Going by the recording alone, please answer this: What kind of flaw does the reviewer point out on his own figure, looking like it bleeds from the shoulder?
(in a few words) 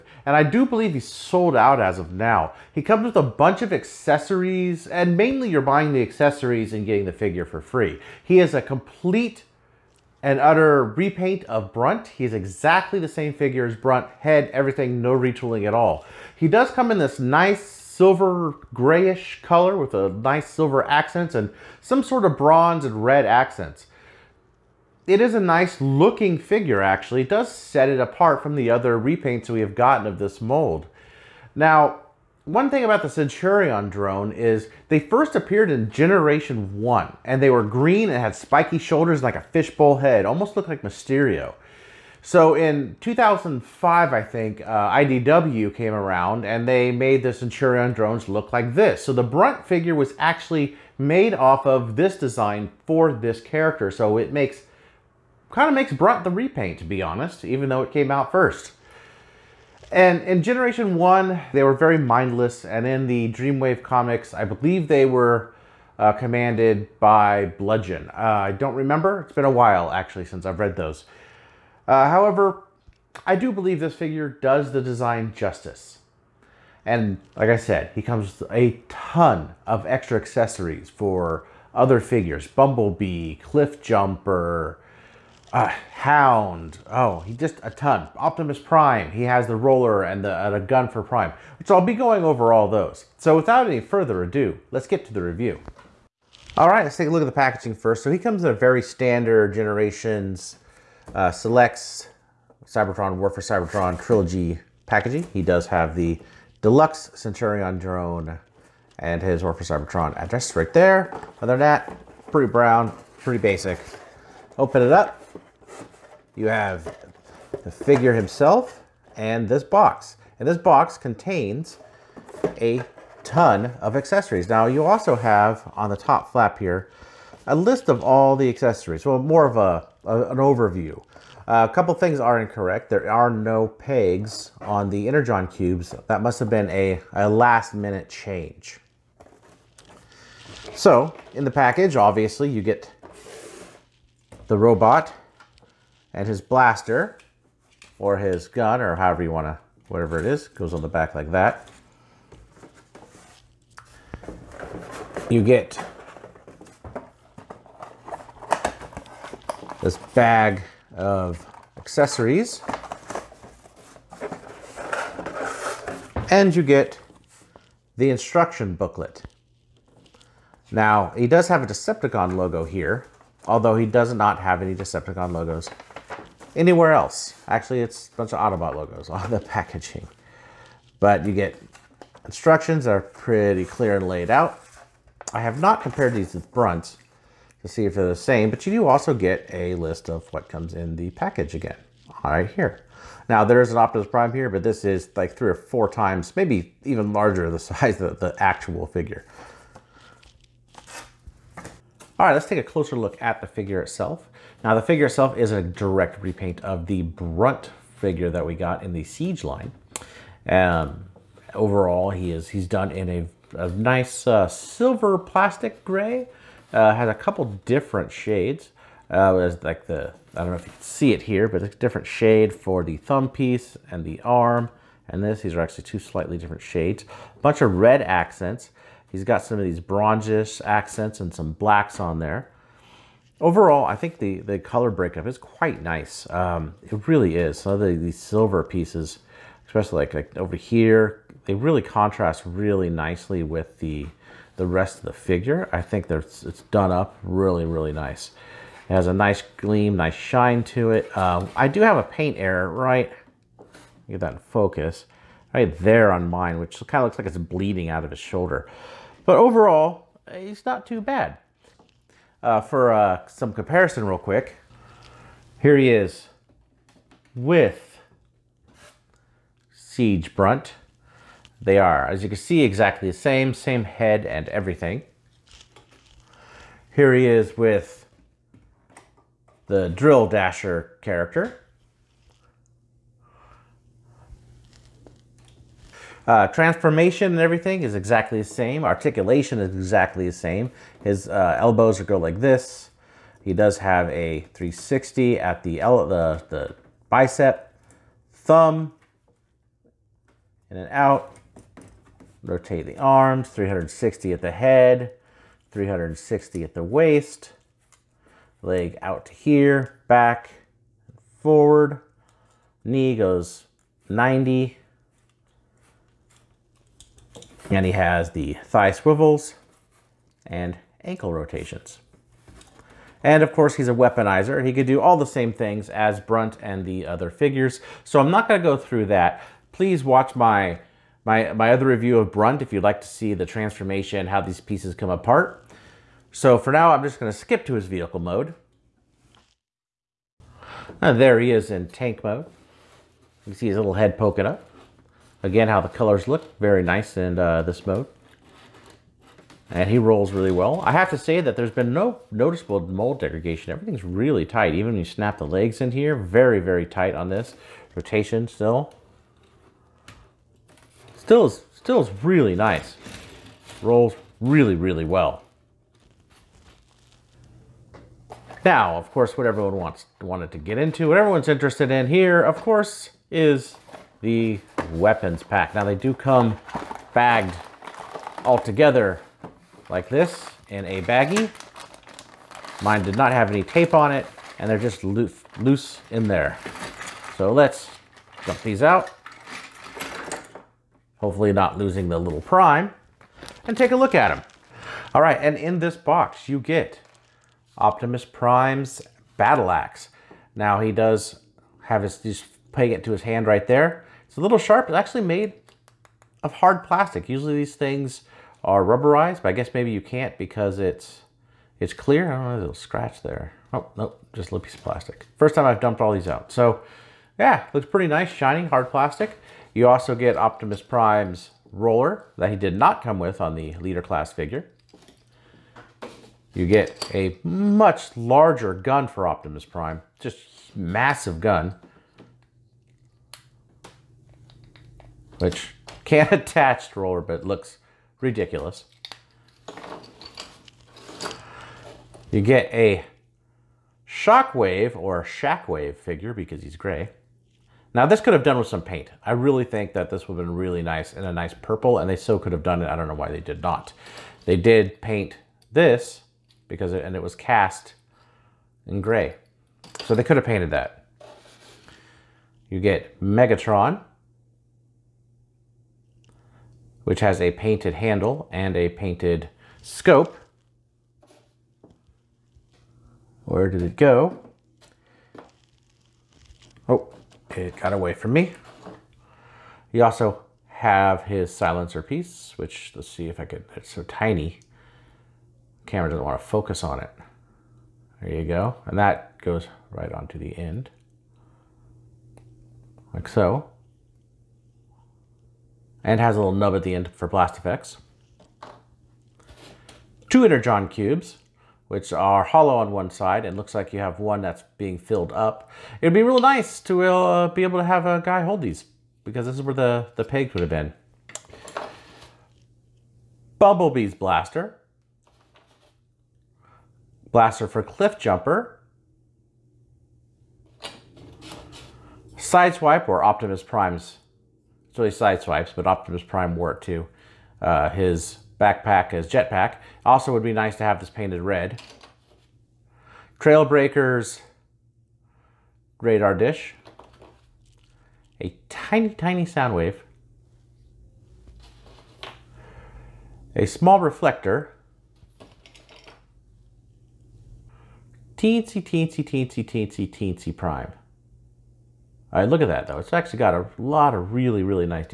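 Paint error.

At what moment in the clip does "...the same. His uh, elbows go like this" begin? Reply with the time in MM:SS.
04:50.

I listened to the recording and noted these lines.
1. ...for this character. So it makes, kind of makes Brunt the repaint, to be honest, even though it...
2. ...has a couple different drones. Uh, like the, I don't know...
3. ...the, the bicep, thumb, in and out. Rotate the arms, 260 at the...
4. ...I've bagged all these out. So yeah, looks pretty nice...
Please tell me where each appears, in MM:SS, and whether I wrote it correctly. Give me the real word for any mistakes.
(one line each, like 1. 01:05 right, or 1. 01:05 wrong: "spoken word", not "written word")
1. 00:52 right
2. 03:36 wrong: "shades", not "drones"
3. 04:55 wrong: "360", not "260"
4. 06:55 wrong: "dumped", not "bagged".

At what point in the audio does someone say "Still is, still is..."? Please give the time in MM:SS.
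06:01.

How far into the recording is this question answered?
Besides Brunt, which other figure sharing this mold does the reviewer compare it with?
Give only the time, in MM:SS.
04:39.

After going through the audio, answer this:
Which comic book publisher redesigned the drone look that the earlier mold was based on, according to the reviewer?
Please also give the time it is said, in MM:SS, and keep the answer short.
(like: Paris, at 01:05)
IDW, at 00:44.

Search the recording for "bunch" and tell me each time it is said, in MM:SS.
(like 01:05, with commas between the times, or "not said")
00:03, 02:58, 03:47.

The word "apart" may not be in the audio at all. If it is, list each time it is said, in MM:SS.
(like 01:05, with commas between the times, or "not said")
00:27, 05:35.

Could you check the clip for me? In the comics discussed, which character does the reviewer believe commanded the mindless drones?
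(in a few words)
Bludgeon.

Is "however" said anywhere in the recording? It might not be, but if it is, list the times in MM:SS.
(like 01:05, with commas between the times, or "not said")
01:12, 02:28.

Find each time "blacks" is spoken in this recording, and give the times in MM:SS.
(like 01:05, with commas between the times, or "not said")
03:51.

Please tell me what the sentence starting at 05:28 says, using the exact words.
So I'm not going to go through that.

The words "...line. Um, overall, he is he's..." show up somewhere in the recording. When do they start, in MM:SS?
03:29.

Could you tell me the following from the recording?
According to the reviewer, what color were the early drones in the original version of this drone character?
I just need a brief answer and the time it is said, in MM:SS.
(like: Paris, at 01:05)
Green, at 00:37.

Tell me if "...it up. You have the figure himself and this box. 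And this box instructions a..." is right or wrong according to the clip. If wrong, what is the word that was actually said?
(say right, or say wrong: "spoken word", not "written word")
wrong: "contains", not "instructions".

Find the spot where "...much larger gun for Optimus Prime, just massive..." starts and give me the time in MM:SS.
07:07.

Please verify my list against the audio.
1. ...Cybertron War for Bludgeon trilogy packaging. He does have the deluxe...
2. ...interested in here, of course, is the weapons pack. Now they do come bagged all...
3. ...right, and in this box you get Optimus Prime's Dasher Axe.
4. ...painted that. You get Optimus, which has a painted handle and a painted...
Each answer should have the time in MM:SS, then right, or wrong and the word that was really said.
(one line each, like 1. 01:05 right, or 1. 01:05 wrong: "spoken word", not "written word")
1. 01:42 wrong: "Cybertron", not "Bludgeon"
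2. 06:11 right
3. 06:35 wrong: "Battle", not "Dasher"
4. 07:40 wrong: "Megatron", not "Optimus".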